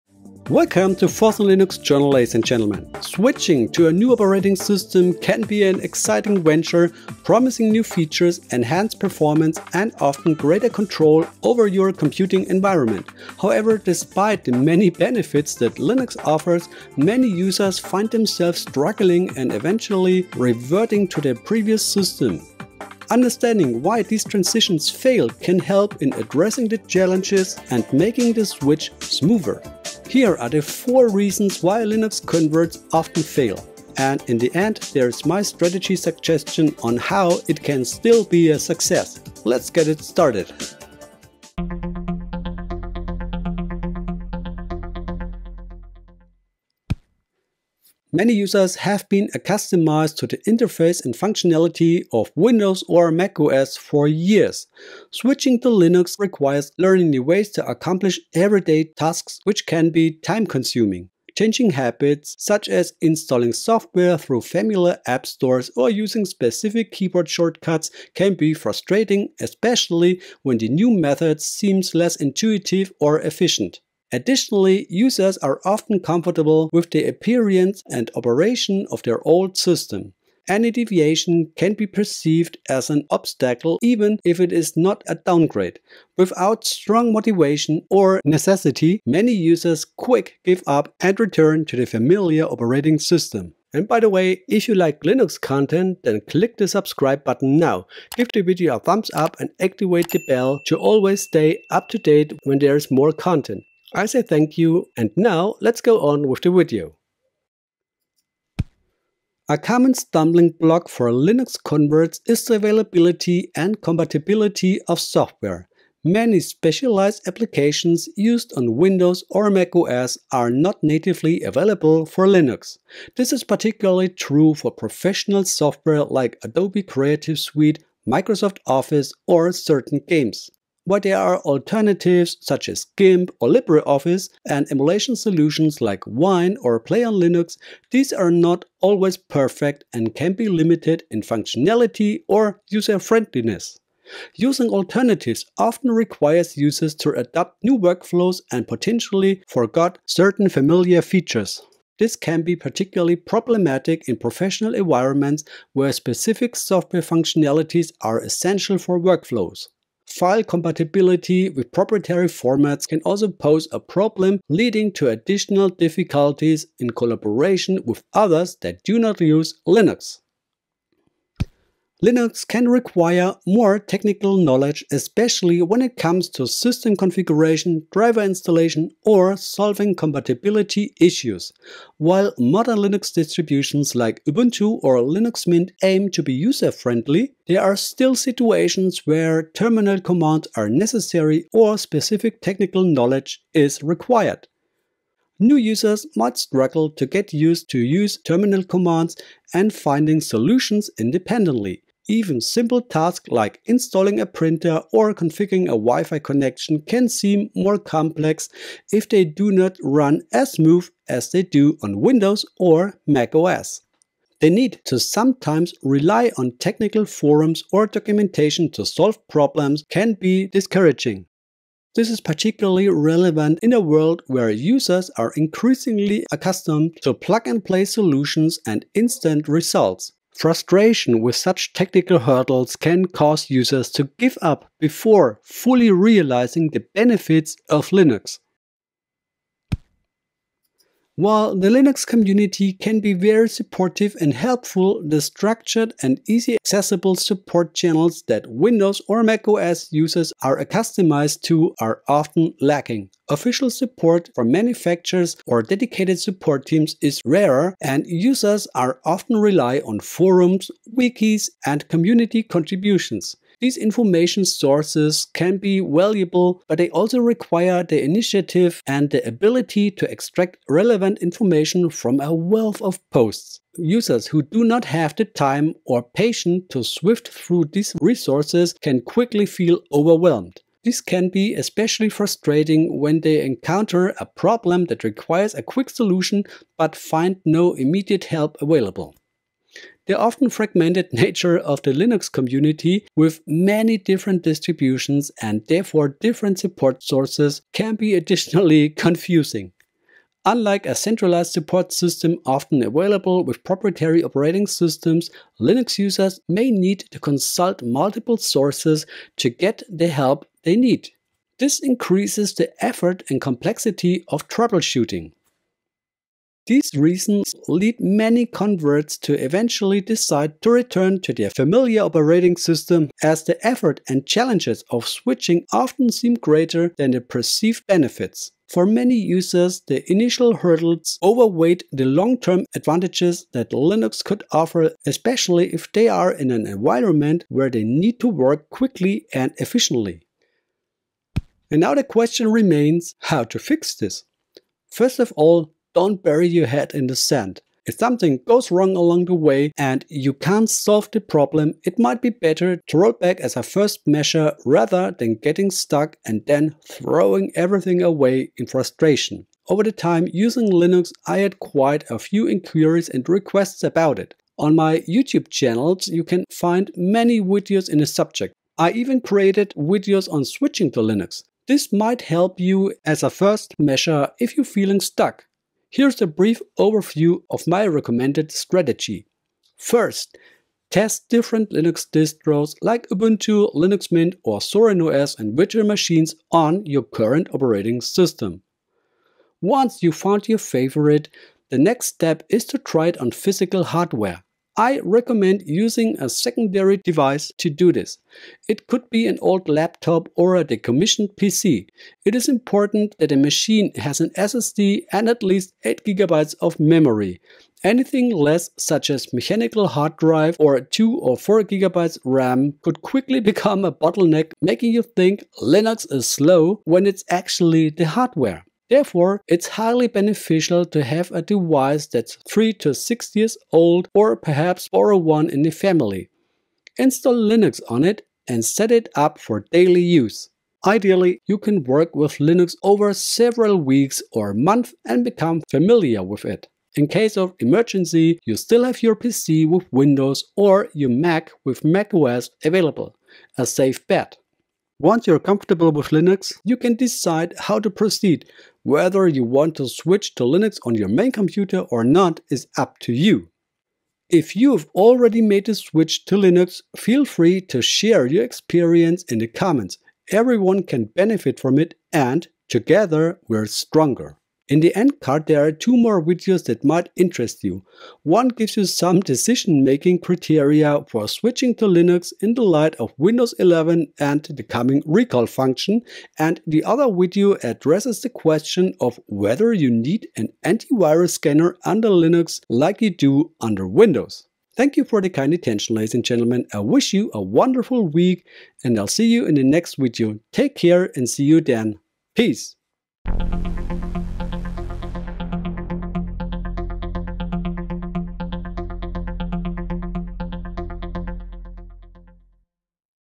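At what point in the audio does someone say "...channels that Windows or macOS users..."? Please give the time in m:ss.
4:07.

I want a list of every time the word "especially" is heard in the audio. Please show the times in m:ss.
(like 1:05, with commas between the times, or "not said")
1:09, 2:54, 4:41, 5:35.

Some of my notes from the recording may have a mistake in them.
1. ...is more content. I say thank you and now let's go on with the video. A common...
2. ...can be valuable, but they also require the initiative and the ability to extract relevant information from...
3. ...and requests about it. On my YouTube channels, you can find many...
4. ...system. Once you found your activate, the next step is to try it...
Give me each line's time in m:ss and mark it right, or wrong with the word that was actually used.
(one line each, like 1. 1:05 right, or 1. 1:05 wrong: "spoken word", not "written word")
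1. 1:42 right
2. 4:25 right
3. 6:03 right
4. 6:27 wrong: "favorite", not "activate".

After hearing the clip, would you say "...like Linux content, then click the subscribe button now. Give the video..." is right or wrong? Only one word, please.
right.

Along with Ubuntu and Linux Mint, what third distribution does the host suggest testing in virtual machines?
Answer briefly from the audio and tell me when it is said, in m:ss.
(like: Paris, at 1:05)
ZorinOS, at 6:24.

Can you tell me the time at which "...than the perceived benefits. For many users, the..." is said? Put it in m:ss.
5:26.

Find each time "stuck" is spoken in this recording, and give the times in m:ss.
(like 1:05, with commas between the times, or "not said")
5:55, 6:15.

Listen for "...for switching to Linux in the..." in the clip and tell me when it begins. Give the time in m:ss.
7:51.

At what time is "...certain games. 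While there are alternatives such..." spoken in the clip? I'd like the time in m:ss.
2:09.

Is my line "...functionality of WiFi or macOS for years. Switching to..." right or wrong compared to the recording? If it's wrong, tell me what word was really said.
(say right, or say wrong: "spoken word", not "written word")
wrong: "Windows", not "WiFi".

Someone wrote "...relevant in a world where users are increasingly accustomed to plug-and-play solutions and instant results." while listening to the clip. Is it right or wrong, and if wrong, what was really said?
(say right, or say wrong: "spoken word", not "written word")
right.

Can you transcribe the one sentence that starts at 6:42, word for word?
It is important that a machine has an SSD and at least 8GB of memory.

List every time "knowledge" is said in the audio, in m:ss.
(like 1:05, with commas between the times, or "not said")
2:54, 3:12.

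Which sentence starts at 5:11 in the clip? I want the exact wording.
This increases the effort and complexity of troubleshooting.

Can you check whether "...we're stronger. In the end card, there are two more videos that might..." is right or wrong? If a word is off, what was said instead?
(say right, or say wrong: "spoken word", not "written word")
right.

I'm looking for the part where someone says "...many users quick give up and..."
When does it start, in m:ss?
1:29.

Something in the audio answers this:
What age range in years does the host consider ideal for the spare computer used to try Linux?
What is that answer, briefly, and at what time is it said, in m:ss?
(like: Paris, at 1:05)
3 to 6 years, at 7:02.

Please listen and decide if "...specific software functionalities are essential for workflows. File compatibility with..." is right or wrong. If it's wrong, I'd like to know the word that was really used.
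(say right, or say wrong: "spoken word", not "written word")
right.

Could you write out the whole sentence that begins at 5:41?
And now the question remains how to fix this.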